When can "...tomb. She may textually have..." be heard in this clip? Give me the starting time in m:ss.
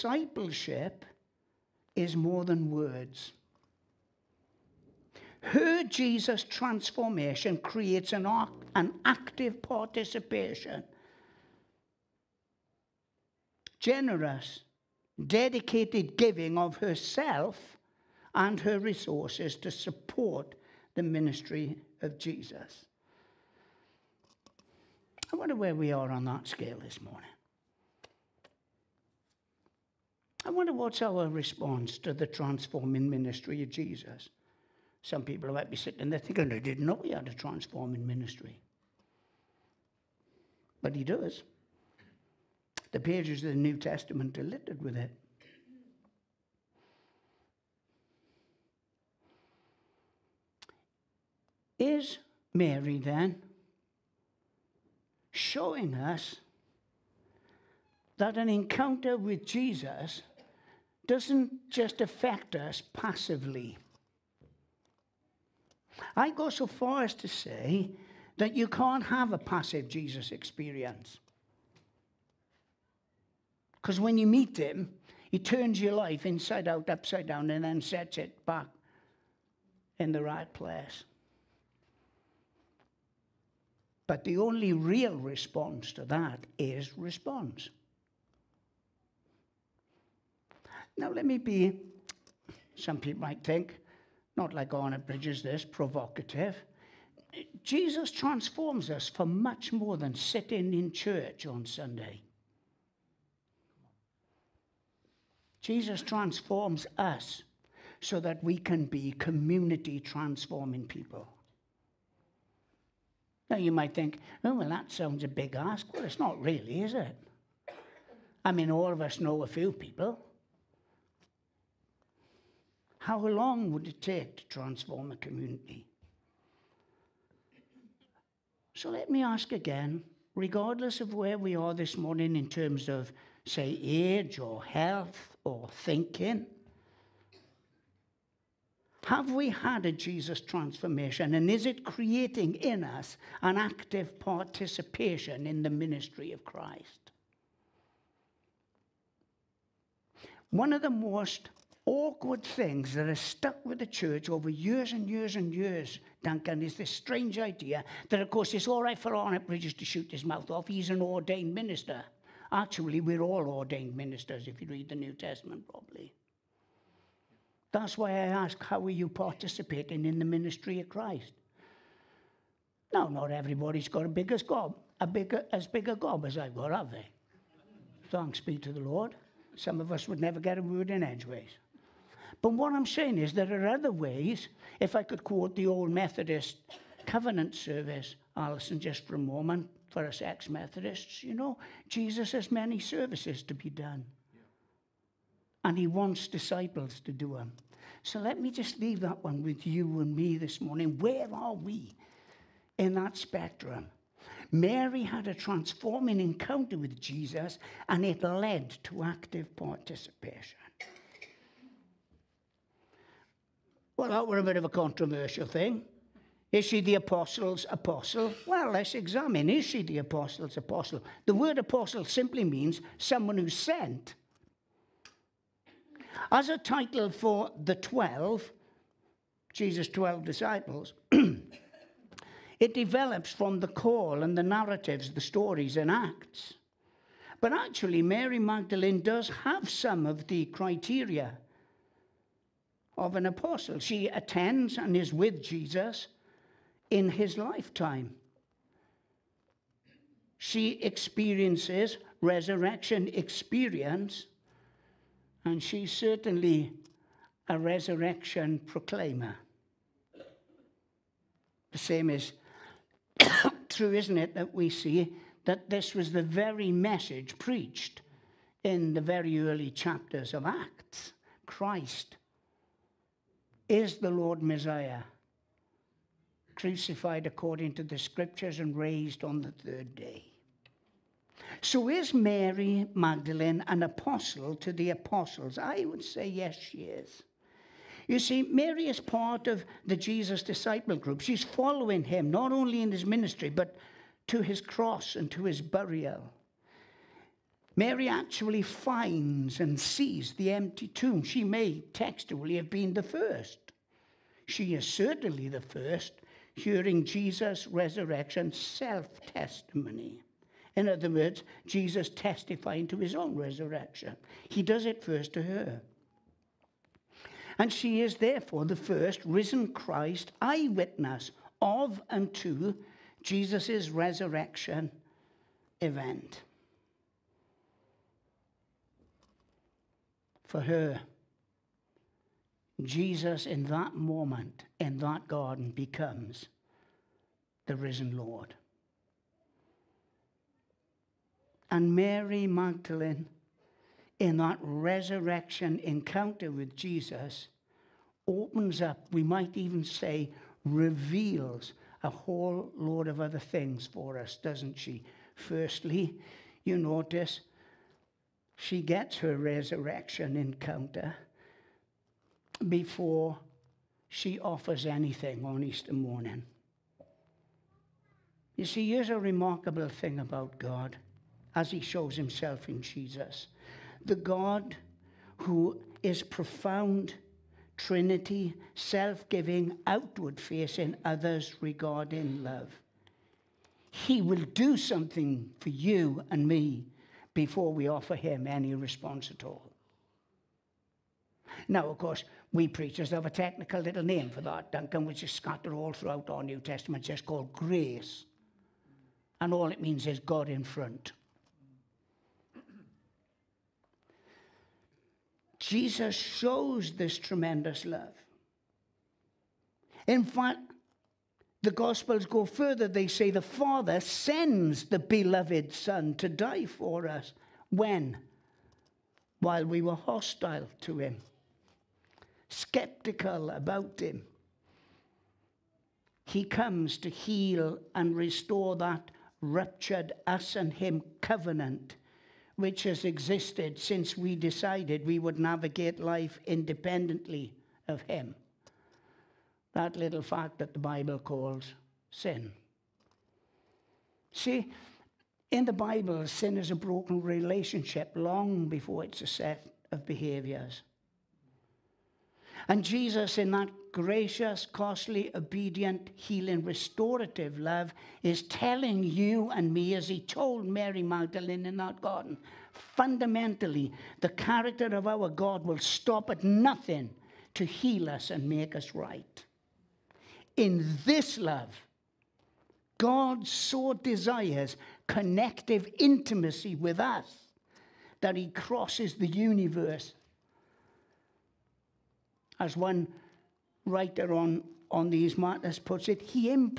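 5:00.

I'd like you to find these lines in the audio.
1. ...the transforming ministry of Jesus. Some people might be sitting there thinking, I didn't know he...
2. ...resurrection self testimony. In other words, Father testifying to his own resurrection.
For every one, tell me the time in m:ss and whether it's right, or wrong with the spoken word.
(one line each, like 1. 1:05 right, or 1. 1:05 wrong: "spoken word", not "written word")
1. 0:32 right
2. 5:07 wrong: "Jesus", not "Father".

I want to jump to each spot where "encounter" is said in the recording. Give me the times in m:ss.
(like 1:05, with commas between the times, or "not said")
0:58, 3:26, 5:45, 6:00.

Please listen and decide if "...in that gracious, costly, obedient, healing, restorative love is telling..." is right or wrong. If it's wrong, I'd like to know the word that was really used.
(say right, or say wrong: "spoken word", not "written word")
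right.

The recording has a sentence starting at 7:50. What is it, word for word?
In this love, God so desires connective intimacy with us that he crosses the universe.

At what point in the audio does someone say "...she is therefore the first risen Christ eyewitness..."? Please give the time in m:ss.
5:17.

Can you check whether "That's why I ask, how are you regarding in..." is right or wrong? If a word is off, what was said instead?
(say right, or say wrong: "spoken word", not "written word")
wrong: "participating", not "regarding".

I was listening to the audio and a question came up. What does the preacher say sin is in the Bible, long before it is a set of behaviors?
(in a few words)
a broken relationship.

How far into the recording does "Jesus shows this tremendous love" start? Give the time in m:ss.
6:45.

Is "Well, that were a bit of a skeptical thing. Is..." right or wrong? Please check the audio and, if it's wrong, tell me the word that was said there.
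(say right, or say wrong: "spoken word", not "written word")
wrong: "controversial", not "skeptical".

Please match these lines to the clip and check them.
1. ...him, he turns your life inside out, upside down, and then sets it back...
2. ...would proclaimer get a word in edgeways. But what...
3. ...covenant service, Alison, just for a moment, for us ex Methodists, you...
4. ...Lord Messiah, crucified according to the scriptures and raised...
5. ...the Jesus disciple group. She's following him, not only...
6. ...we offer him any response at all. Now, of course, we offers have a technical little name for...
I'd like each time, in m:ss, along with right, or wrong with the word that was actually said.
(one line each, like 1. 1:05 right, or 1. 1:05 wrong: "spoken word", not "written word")
1. 1:14 right
2. 3:00 wrong: "never", not "proclaimer"
3. 3:07 right
4. 4:34 right
5. 4:49 right
6. 6:27 wrong: "preachers", not "offers".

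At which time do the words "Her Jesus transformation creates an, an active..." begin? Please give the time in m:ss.
0:05.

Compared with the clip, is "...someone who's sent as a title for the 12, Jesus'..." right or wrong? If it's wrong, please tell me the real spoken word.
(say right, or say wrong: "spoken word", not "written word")
right.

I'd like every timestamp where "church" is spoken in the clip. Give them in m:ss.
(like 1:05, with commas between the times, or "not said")
1:40, 2:33.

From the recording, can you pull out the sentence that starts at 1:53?
Now you might think, oh, well, that sounds a big ask.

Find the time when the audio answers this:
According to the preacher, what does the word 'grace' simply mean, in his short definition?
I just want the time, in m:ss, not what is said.
6:40.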